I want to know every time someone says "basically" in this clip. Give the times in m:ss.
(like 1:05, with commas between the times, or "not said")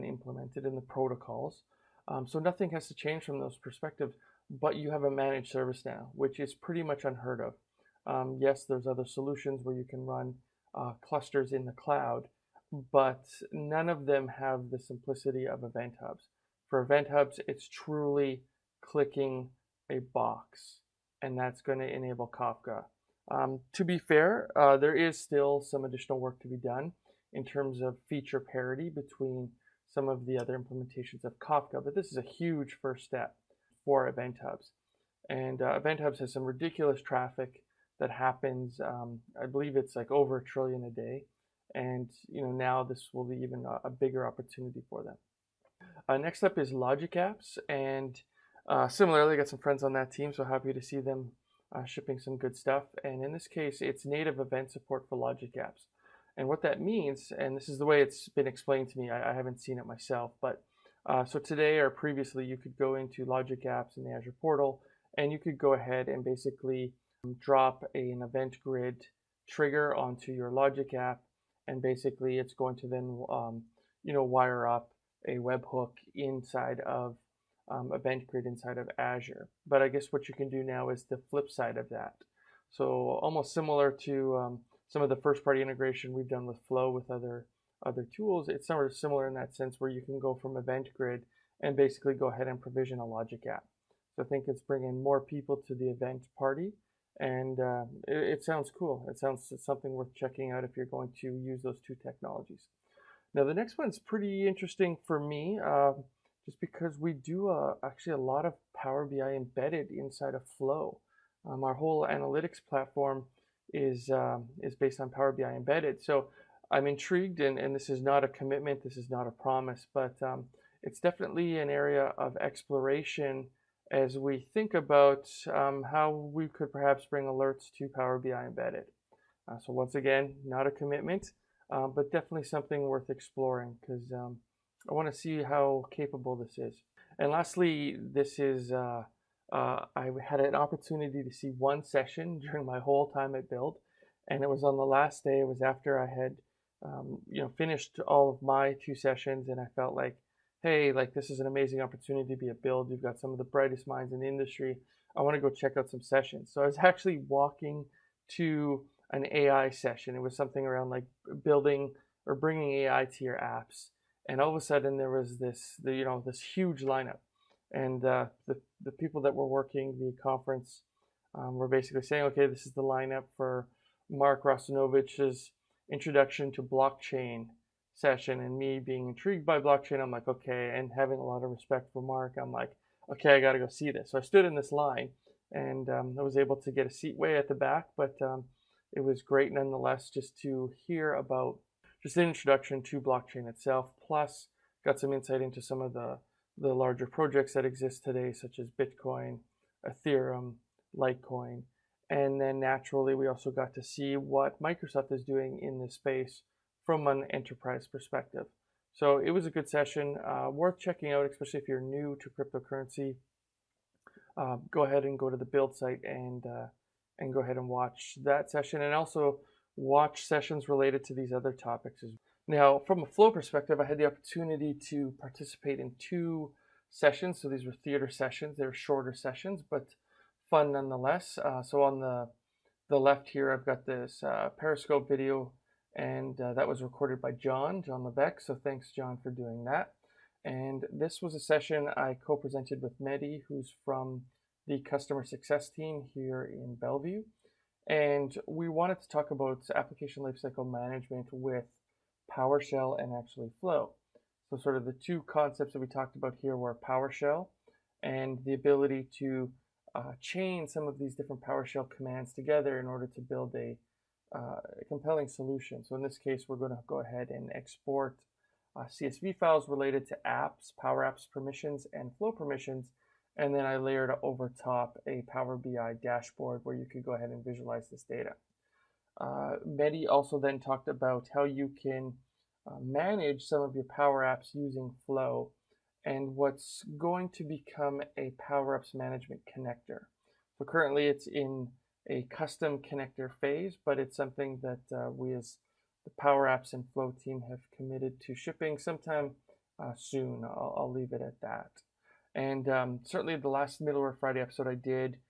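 1:06, 1:11, 1:31, 2:51.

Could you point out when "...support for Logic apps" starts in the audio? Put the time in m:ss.
0:54.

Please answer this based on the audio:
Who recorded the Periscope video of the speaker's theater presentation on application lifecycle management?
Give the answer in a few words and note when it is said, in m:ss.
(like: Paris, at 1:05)
John Levesque, at 3:57.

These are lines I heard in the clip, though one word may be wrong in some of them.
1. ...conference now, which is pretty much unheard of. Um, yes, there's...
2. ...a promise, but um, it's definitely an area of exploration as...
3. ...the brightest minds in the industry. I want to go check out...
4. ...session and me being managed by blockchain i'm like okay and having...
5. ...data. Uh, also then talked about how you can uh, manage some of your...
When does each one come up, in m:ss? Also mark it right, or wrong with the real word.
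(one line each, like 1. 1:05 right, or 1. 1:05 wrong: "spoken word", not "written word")
1. 0:05 wrong: "service", not "conference"
2. 1:59 right
3. 2:33 right
4. 2:57 wrong: "intrigued", not "managed"
5. 4:38 right.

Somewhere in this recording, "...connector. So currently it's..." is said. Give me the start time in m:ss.
4:49.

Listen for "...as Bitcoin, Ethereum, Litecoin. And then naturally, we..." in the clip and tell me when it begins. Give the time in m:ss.
3:18.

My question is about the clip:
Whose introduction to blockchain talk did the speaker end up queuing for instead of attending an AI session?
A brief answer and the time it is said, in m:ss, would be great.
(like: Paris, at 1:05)
Mark Russinovich, at 2:54.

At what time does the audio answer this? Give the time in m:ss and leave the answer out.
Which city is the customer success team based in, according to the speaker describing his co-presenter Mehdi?
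4:06.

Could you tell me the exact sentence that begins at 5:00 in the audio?
I'll, I'll leave it at that.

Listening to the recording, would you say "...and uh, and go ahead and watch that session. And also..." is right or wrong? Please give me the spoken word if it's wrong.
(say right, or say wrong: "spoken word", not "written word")
right.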